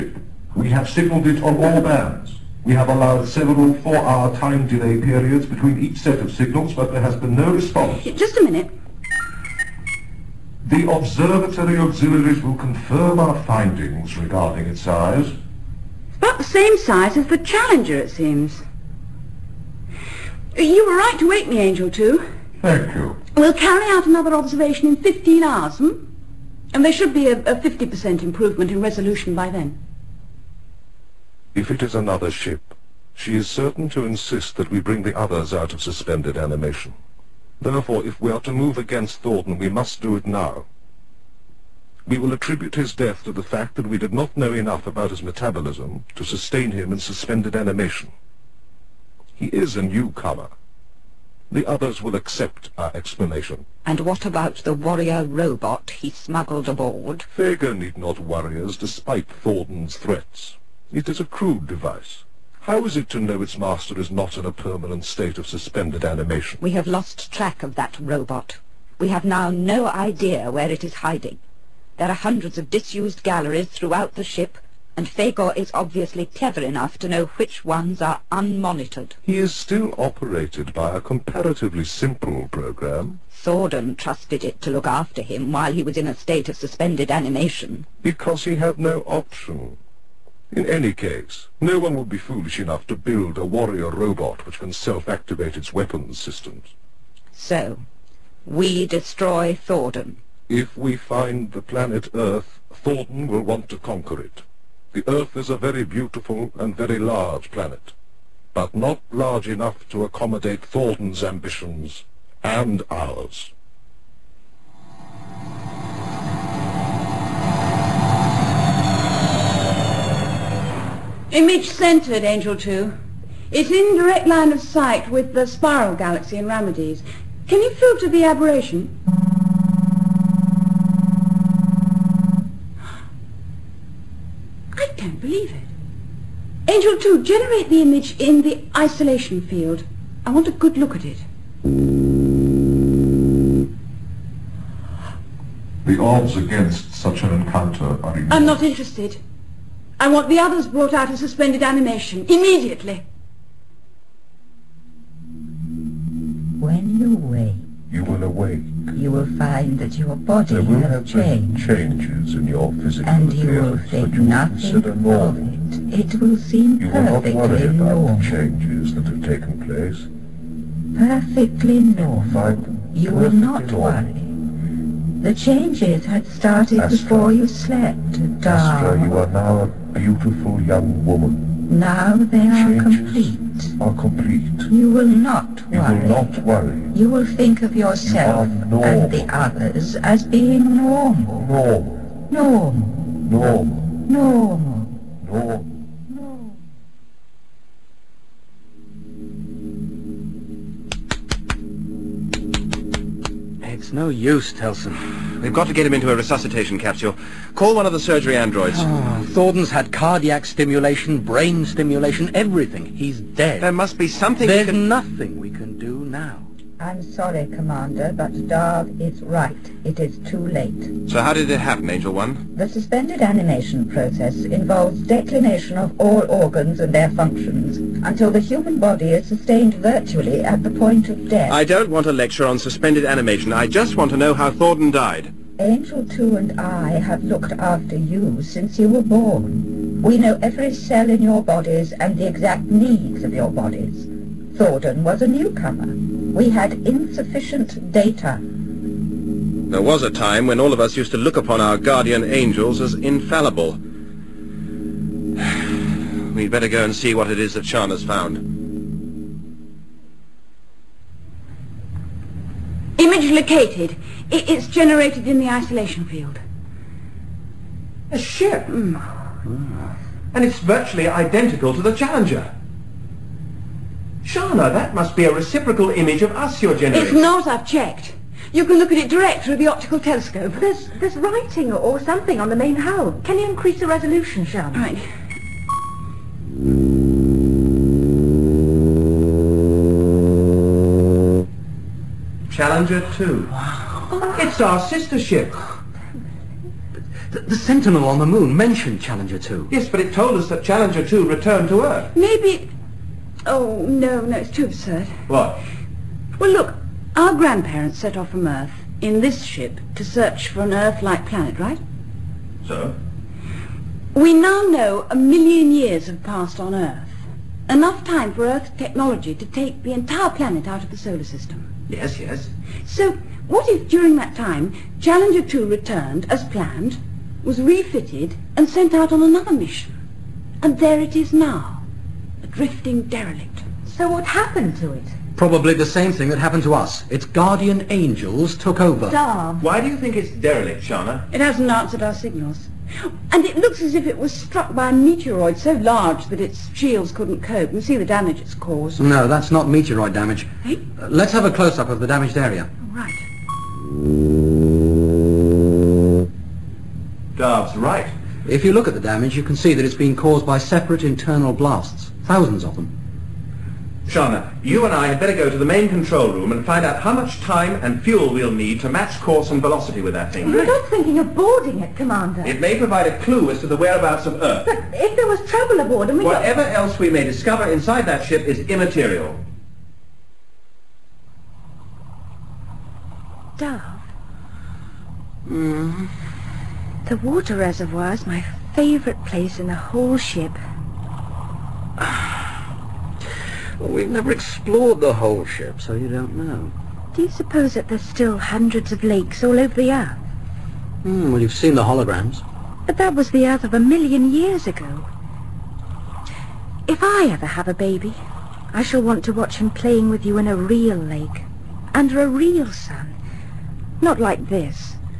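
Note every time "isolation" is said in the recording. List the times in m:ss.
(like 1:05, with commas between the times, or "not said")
2:18, 4:25.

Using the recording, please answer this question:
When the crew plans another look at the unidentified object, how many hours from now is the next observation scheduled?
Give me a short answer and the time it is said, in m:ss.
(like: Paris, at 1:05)
15, at 0:24.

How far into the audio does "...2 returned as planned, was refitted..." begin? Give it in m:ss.
5:25.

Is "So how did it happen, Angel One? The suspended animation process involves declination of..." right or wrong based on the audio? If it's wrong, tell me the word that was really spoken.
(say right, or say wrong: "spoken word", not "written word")
right.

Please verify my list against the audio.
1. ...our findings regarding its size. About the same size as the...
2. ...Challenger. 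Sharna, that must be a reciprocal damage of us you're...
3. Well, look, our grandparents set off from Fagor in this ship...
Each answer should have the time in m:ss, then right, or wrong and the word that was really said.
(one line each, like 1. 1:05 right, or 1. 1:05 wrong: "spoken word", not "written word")
1. 0:13 right
2. 4:31 wrong: "image", not "damage"
3. 5:06 wrong: "Earth", not "Fagor".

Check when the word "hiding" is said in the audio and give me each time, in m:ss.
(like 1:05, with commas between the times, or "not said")
1:11.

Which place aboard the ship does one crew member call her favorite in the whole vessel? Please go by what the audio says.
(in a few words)
The water reservoir.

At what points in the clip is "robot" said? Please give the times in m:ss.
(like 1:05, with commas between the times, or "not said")
0:55, 1:07, 1:33.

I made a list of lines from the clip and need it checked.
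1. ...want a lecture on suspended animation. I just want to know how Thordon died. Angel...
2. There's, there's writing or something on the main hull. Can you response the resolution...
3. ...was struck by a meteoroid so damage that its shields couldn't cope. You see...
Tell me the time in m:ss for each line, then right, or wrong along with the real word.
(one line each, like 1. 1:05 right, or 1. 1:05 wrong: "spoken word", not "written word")
1. 3:51 right
2. 4:40 wrong: "increase", not "response"
3. 5:44 wrong: "large", not "damage".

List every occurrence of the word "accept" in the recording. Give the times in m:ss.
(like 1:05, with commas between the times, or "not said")
0:52.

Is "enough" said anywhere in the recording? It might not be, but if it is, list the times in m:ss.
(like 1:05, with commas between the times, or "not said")
0:44, 1:16, 1:32, 1:49, 5:17.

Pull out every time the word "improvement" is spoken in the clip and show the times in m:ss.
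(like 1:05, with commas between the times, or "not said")
0:28.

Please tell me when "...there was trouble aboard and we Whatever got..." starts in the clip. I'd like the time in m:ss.
6:15.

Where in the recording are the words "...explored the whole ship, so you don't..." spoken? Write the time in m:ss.
6:34.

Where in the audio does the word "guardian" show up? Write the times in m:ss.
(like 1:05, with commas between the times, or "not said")
4:11, 5:37.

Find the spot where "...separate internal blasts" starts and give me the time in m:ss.
6:00.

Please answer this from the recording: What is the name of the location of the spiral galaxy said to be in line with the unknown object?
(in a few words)
Ramides.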